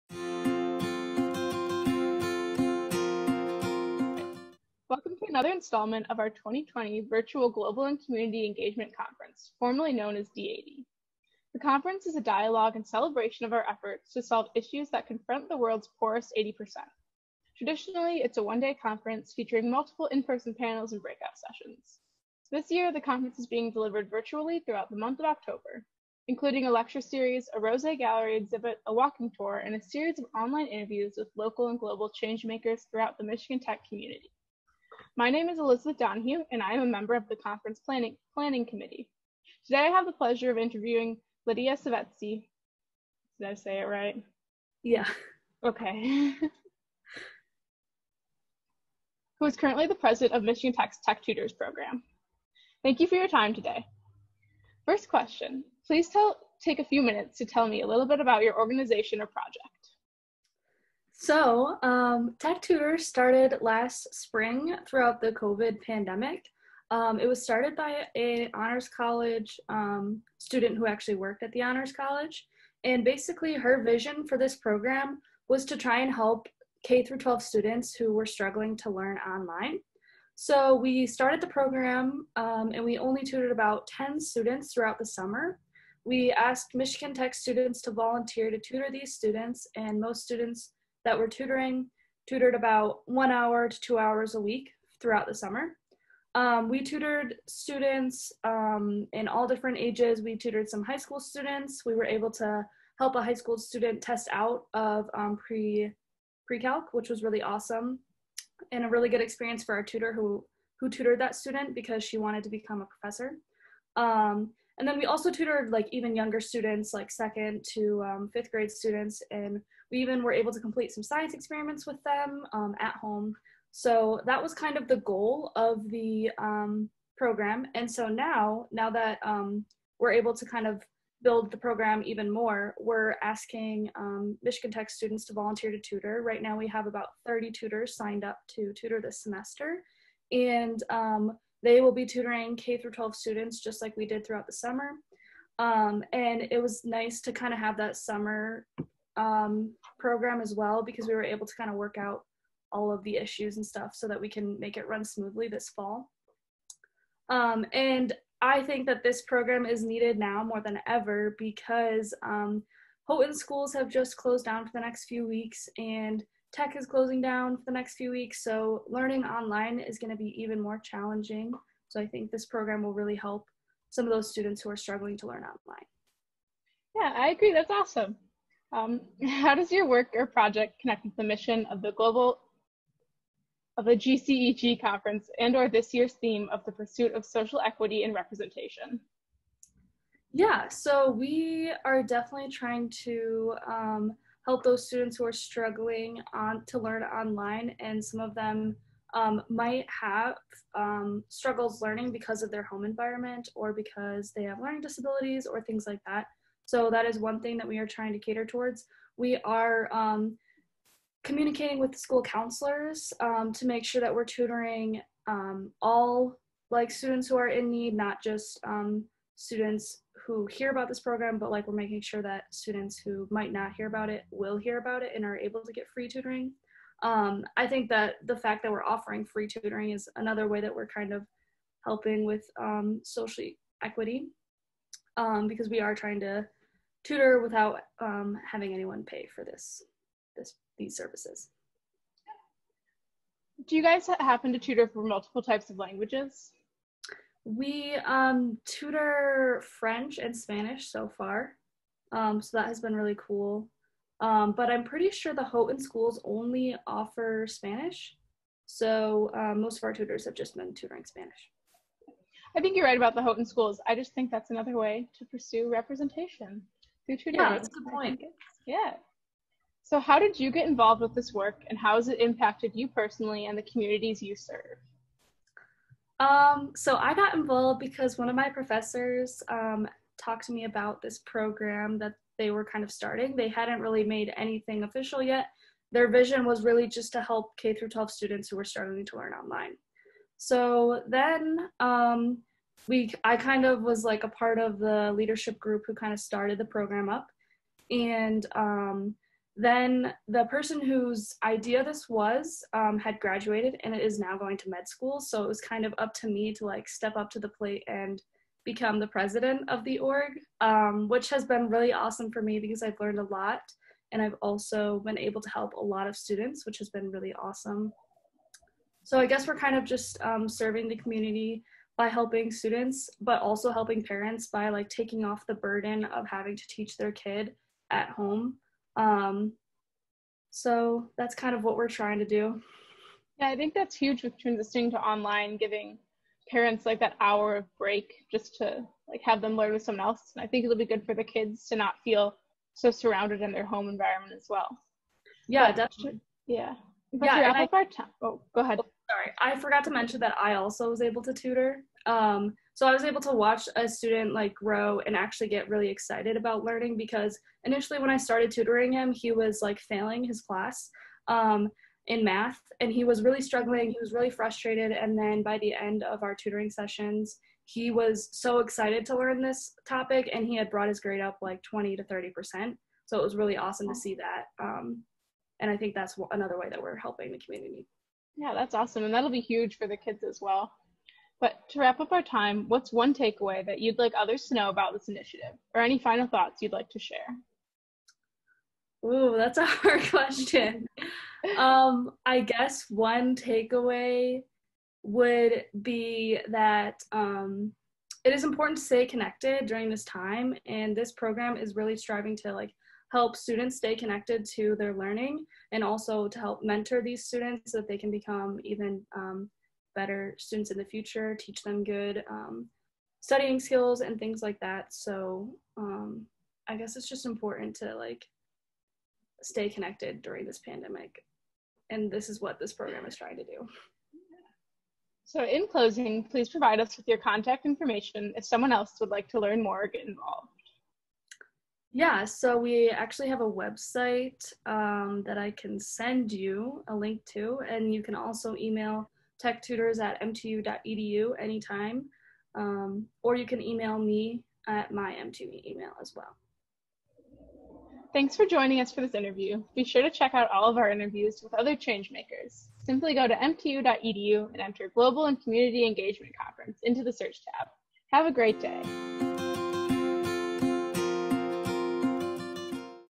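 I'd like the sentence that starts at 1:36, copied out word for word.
Um, we tutored students um, in all different ages.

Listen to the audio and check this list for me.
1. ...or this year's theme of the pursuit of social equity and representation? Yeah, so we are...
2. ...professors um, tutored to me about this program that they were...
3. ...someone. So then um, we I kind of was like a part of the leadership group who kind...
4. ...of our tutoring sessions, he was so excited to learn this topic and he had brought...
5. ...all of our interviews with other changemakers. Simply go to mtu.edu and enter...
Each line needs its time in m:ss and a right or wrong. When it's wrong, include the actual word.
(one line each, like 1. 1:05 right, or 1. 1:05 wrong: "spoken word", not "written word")
1. 3:05 right
2. 4:38 wrong: "talked", not "tutored"
3. 4:49 wrong: "online", not "someone"
4. 6:06 right
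5. 7:30 right.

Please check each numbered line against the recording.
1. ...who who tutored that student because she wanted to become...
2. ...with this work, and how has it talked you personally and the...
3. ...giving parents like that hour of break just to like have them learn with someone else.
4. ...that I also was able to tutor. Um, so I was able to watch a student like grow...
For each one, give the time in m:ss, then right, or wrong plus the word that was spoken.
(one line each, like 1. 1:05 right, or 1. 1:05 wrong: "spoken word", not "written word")
1. 1:50 right
2. 4:31 wrong: "impacted", not "talked"
3. 5:35 right
4. 5:50 right.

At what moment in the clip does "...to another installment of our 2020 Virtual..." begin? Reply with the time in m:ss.
0:05.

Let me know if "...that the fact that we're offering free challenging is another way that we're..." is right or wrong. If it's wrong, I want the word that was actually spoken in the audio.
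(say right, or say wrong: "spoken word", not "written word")
wrong: "tutoring", not "challenging".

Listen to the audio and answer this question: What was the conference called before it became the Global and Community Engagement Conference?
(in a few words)
D80.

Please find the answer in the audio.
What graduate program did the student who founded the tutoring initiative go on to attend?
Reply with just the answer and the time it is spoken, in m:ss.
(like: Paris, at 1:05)
Med school, at 5:04.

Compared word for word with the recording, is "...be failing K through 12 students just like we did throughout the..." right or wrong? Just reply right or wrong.
wrong.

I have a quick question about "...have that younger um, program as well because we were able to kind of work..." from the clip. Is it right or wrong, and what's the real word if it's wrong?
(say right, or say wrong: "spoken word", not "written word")
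wrong: "summer", not "younger".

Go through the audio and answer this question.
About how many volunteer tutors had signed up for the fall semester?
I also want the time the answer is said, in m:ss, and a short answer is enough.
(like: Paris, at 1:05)
30, at 2:17.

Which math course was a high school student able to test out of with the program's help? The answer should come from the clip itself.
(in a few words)
Pre-calc.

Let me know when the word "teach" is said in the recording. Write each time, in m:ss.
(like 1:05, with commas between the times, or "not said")
5:26, 6:51.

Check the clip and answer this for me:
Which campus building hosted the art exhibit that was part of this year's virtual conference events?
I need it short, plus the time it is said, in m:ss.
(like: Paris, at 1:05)
Rozsa Gallery, at 0:27.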